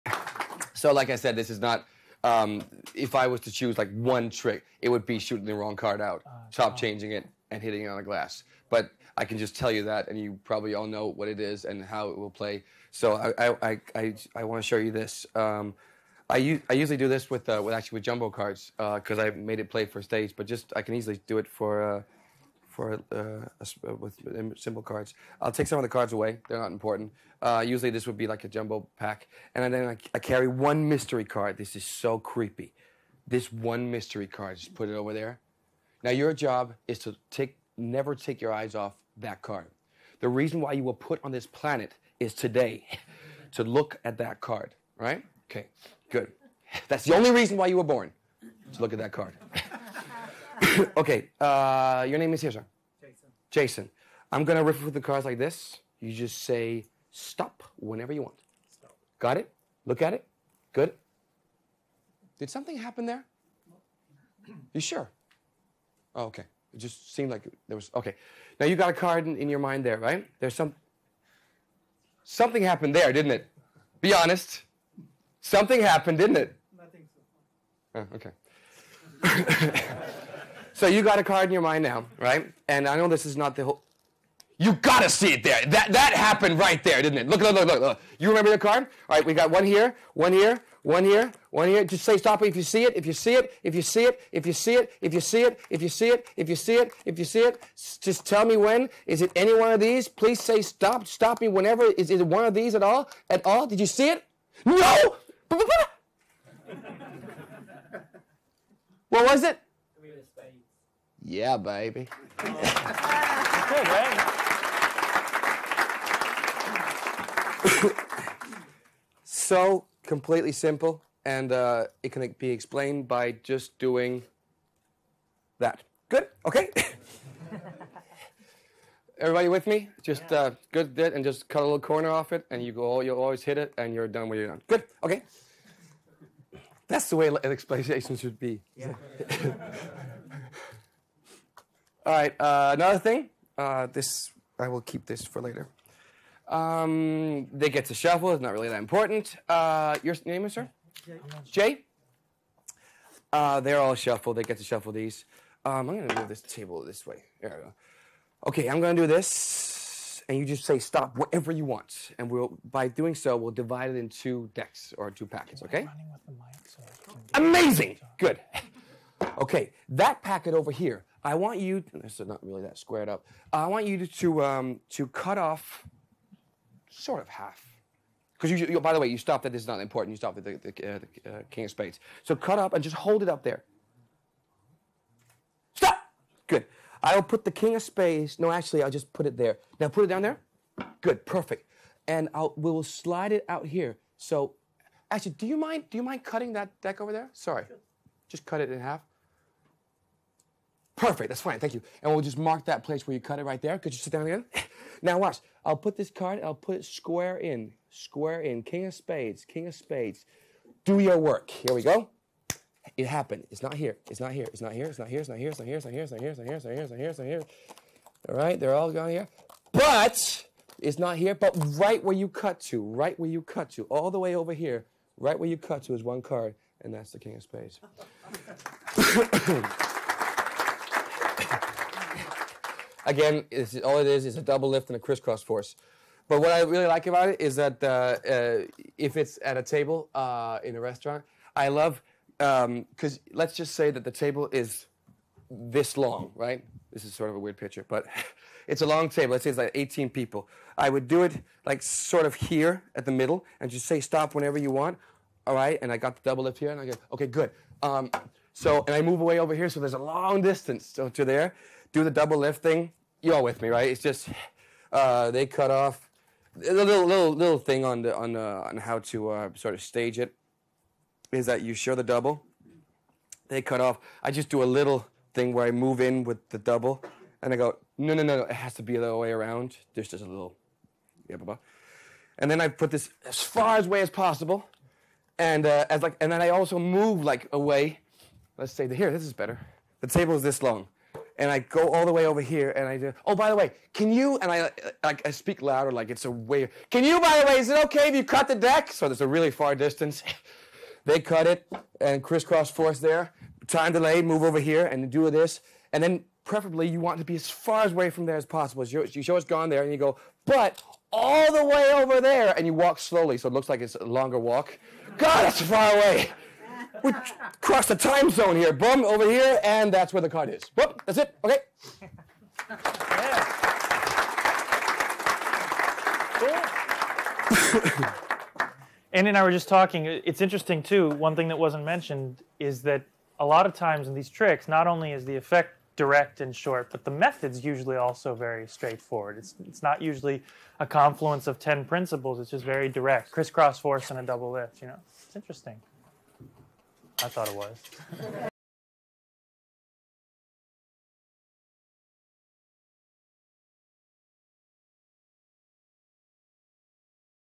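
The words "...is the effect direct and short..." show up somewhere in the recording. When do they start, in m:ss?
5:35.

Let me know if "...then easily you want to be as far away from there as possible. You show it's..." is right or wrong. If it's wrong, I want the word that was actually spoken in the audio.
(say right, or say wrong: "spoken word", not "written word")
wrong: "preferably", not "easily".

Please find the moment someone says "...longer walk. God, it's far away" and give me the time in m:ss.
5:14.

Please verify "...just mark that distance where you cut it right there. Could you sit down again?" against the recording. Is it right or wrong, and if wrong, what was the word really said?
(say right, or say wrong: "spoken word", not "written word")
wrong: "place", not "distance".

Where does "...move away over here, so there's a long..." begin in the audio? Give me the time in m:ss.
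4:19.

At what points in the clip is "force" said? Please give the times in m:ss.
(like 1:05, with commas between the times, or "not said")
3:55, 5:02, 5:43.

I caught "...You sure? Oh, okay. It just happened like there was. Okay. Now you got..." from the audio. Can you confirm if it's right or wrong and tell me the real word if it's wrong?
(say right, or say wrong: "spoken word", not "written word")
wrong: "seemed", not "happened".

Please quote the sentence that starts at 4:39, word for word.
There's just a little, yeah, blah, blah.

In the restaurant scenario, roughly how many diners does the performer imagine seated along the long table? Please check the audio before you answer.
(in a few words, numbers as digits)
18.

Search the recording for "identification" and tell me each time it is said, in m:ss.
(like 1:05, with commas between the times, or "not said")
not said.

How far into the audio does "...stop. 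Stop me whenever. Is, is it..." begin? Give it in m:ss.
1:40.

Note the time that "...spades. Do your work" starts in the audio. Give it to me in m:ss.
3:29.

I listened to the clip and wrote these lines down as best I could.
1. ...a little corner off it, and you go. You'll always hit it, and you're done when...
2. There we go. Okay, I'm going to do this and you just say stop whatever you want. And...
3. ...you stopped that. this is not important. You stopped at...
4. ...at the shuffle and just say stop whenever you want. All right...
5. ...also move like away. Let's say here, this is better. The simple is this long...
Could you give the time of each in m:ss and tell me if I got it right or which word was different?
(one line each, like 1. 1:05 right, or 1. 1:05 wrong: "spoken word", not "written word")
1. 2:11 right
2. 2:37 right
3. 2:59 right
4. 4:12 wrong: "middle", not "shuffle"
5. 4:46 wrong: "table", not "simple".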